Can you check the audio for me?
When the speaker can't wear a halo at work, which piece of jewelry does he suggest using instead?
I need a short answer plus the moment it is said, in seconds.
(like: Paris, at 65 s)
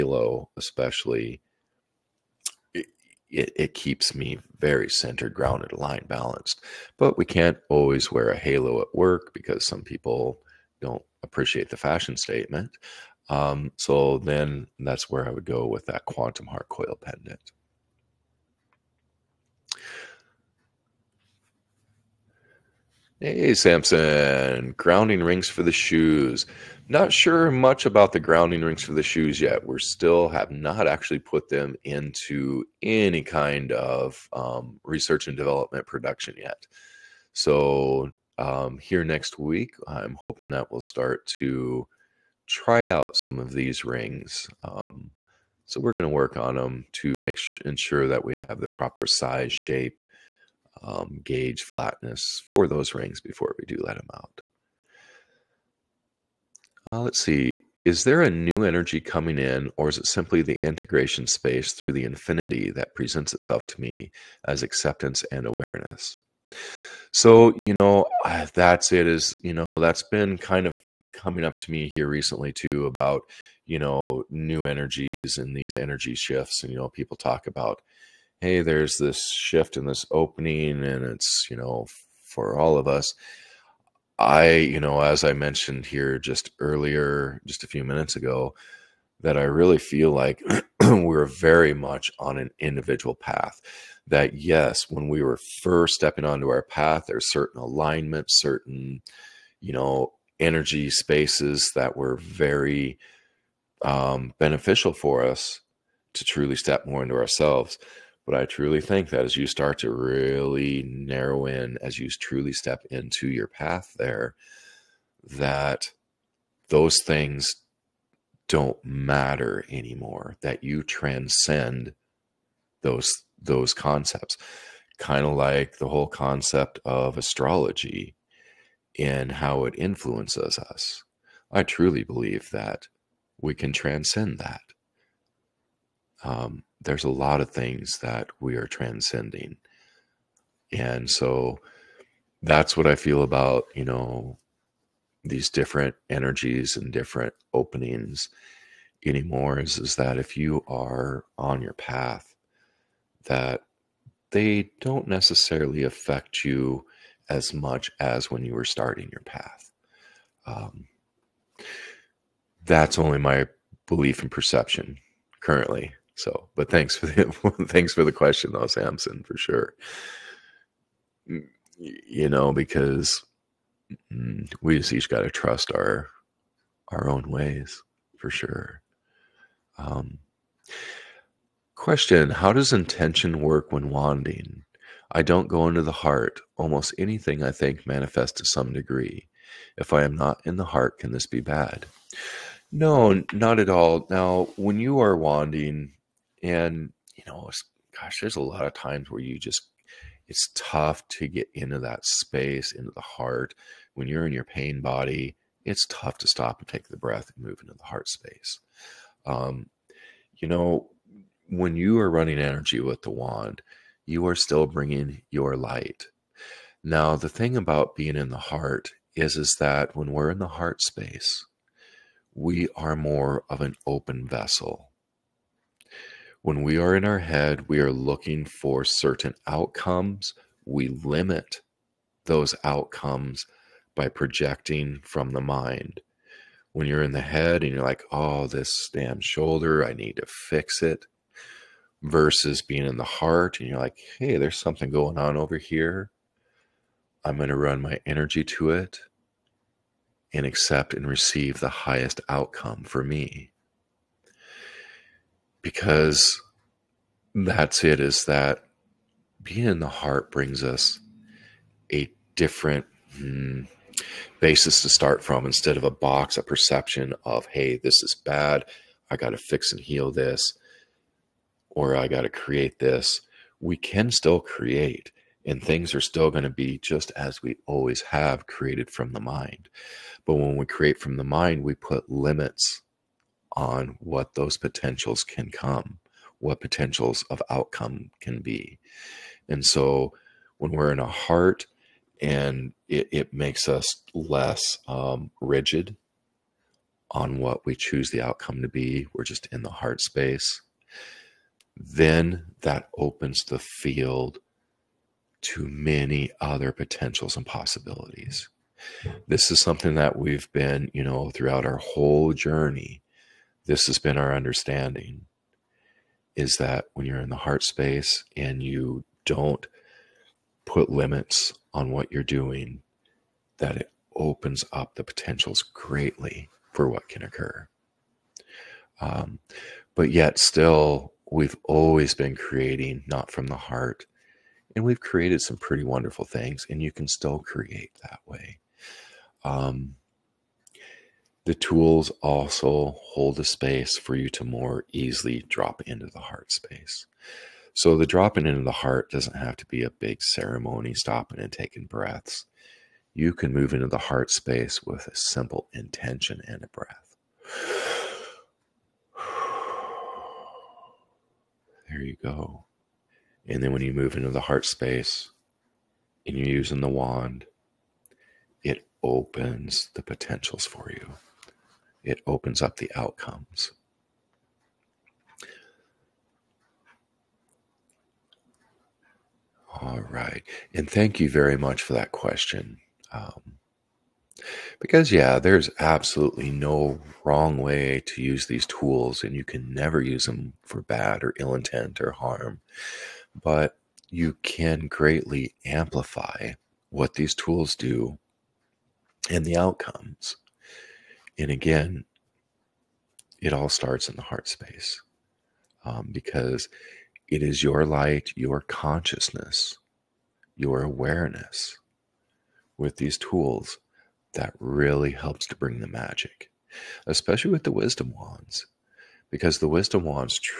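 quantum heart coil pendant, at 16 s.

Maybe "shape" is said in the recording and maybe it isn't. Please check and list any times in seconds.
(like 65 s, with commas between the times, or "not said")
49 s.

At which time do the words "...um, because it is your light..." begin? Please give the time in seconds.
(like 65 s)
405 s.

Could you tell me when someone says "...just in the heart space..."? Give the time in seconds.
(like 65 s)
299 s.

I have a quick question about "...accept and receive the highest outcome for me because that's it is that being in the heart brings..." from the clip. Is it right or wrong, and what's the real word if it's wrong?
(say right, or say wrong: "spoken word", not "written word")
right.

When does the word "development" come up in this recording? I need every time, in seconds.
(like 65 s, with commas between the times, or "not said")
35 s.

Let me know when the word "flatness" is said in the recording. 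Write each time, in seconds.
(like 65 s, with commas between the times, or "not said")
51 s.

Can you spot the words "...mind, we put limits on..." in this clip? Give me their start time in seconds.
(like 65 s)
281 s.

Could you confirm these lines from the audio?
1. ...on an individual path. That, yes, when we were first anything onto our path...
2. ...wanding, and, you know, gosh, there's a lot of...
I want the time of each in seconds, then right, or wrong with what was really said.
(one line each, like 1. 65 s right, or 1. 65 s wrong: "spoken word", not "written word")
1. 92 s wrong: "stepping", not "anything"
2. 195 s right.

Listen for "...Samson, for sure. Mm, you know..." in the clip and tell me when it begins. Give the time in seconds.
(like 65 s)
168 s.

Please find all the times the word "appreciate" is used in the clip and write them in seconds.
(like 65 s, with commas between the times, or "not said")
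11 s.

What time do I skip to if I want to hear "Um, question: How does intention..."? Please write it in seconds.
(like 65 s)
179 s.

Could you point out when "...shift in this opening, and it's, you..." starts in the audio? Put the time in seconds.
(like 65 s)
79 s.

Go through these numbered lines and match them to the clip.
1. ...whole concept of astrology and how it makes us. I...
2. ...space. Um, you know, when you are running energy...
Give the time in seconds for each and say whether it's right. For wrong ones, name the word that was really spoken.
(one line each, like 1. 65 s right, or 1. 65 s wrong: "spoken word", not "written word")
1. 125 s wrong: "influences", not "makes"
2. 208 s right.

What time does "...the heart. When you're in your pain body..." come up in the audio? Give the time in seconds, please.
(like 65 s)
202 s.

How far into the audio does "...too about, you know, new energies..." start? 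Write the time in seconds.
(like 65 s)
72 s.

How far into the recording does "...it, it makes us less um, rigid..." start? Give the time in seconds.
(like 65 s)
292 s.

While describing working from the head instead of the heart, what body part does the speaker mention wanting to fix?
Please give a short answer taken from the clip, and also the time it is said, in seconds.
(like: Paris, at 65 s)
shoulder, at 239 s.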